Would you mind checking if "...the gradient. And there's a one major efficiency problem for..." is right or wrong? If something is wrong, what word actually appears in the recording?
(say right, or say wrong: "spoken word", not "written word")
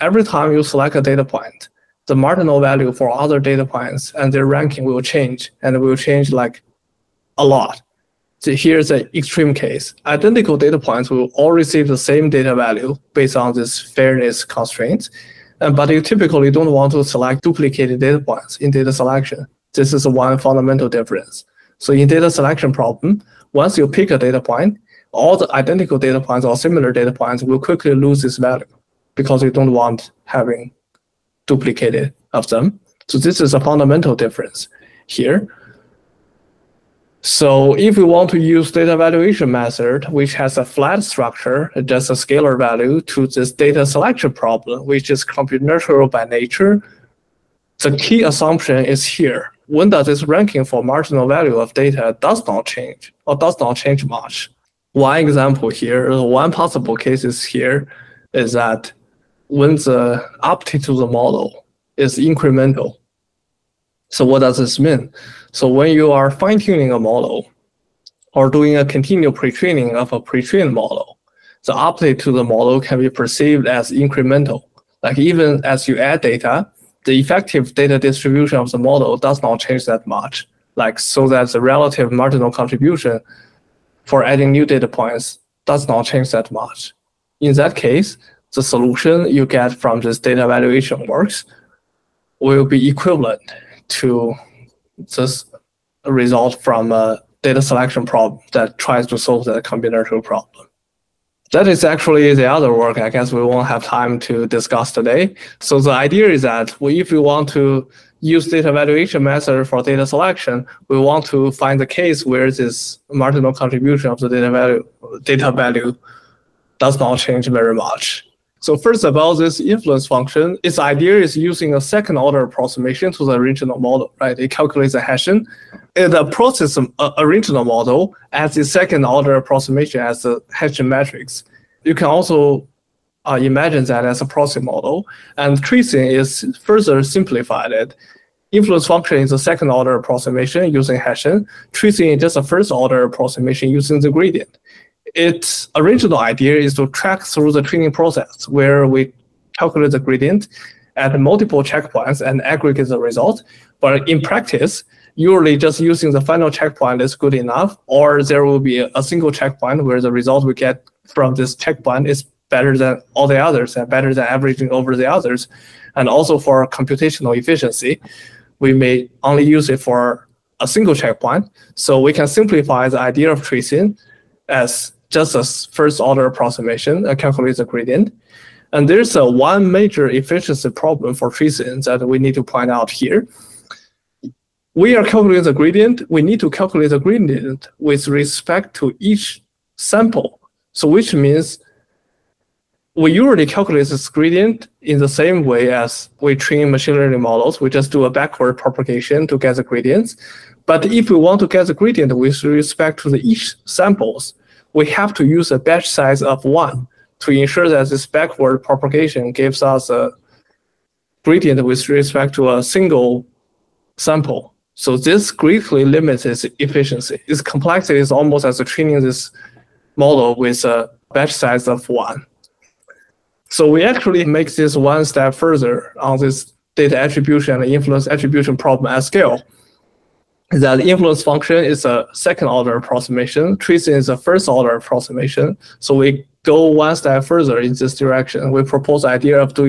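right.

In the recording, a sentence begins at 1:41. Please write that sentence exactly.
That is actually the other work I guess we won't have time to discuss today.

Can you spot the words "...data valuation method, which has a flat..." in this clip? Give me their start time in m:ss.
0:38.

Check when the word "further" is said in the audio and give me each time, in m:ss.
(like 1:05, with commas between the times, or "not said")
2:16, 3:45, 3:57.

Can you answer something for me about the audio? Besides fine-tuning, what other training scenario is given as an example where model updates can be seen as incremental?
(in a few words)
continual pre-training.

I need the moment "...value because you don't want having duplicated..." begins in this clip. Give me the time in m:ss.
0:28.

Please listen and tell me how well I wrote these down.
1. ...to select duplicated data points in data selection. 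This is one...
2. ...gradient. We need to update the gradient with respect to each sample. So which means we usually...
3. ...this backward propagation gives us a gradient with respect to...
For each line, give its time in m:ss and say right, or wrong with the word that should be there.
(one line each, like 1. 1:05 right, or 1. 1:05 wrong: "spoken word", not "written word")
1. 0:16 right
2. 3:05 wrong: "calculate", not "update"
3. 3:27 right.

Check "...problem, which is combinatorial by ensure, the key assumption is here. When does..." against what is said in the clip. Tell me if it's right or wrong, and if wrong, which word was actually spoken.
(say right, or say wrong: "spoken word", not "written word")
wrong: "nature", not "ensure".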